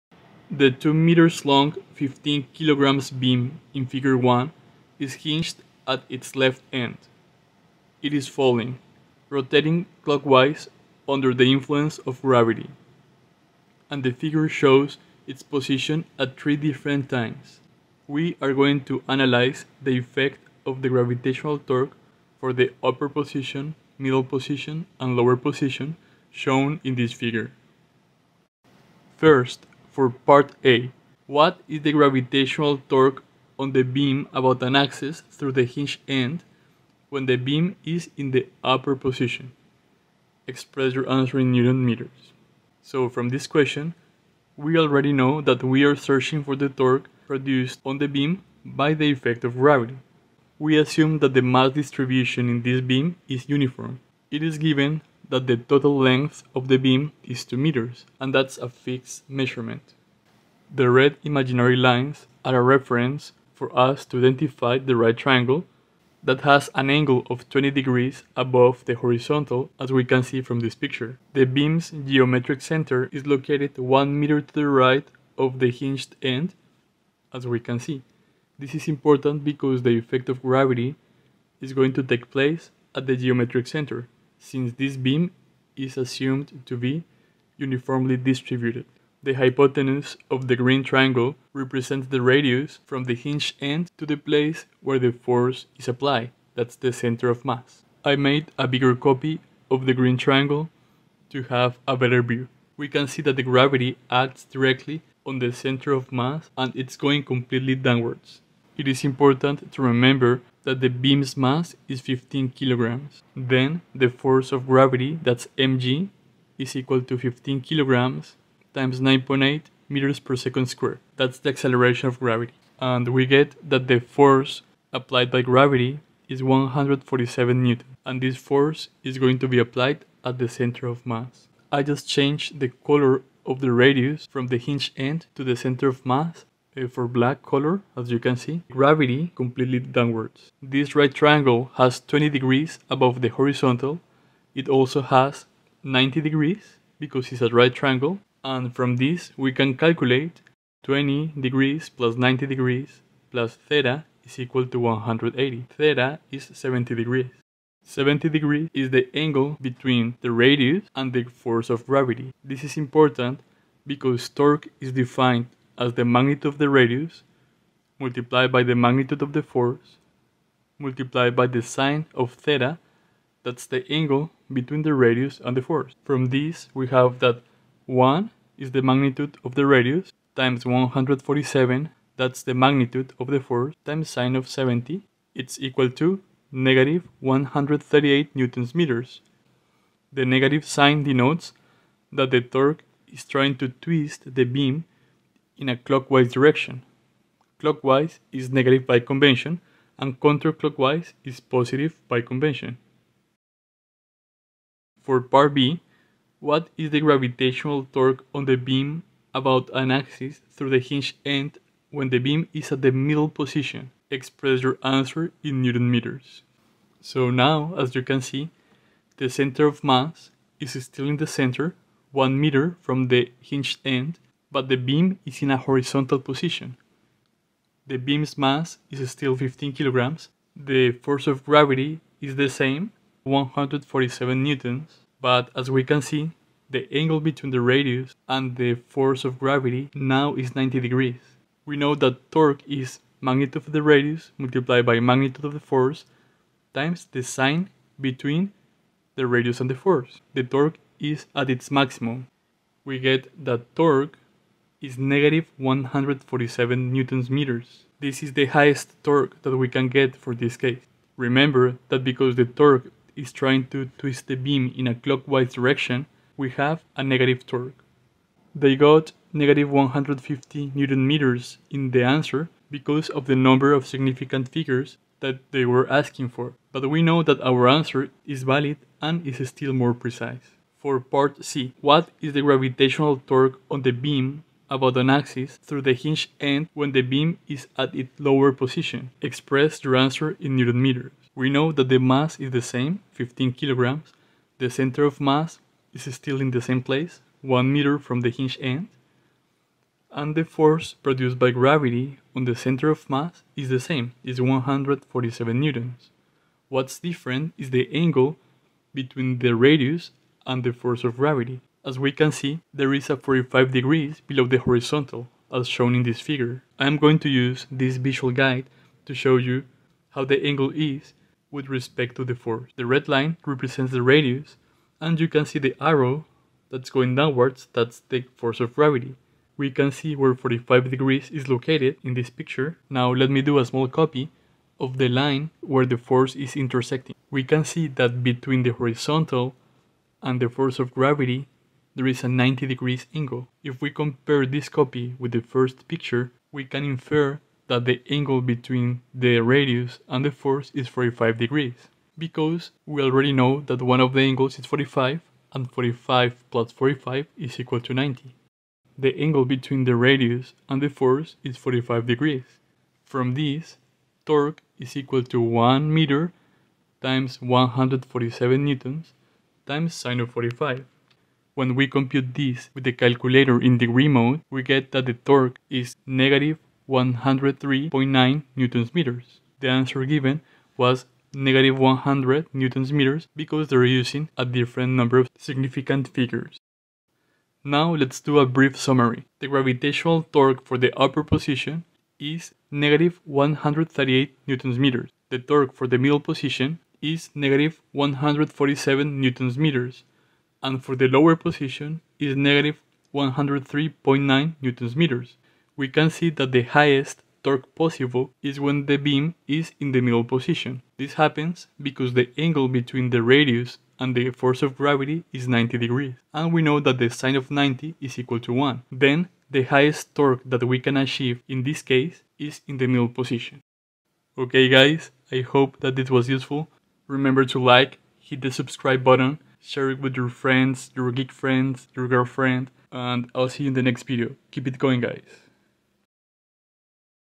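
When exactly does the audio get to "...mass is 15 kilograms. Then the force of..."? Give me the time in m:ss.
1:51.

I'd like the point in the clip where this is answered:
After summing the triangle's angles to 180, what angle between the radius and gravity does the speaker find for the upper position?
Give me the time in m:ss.
2:35.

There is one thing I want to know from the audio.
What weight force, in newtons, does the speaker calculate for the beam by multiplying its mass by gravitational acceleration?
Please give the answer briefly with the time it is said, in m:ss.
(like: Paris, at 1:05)
147 newton, at 2:06.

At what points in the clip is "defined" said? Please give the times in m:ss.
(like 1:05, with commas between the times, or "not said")
2:44.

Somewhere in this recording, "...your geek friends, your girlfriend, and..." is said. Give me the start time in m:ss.
7:10.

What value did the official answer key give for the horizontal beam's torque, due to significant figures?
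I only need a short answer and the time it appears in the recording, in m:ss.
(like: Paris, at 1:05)
-150 newton meters, at 4:29.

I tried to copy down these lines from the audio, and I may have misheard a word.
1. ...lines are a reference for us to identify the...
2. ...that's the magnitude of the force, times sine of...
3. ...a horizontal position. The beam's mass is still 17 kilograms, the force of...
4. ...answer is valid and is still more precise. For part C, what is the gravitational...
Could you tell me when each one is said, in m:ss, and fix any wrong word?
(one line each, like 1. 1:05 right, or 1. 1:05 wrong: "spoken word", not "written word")
1. 1:01 right
2. 3:02 right
3. 3:45 wrong: "15", not "17"
4. 4:37 right.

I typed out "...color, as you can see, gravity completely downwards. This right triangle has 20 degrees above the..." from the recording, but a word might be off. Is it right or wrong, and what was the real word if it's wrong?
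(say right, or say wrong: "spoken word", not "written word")
right.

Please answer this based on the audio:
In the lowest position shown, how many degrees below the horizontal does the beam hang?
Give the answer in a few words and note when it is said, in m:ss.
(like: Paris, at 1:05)
45 degrees, at 5:13.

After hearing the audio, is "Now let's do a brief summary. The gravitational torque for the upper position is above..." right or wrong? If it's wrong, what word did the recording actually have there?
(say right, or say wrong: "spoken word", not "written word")
wrong: "negative", not "above".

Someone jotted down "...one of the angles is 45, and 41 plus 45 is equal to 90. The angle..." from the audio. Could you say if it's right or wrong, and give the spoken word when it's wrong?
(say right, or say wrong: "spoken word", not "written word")
wrong: "45", not "41".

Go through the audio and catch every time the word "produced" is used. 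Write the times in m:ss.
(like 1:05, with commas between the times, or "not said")
0:47, 5:01.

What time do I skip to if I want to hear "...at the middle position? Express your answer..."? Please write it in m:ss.
3:32.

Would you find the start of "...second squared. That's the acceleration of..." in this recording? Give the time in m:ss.
2:00.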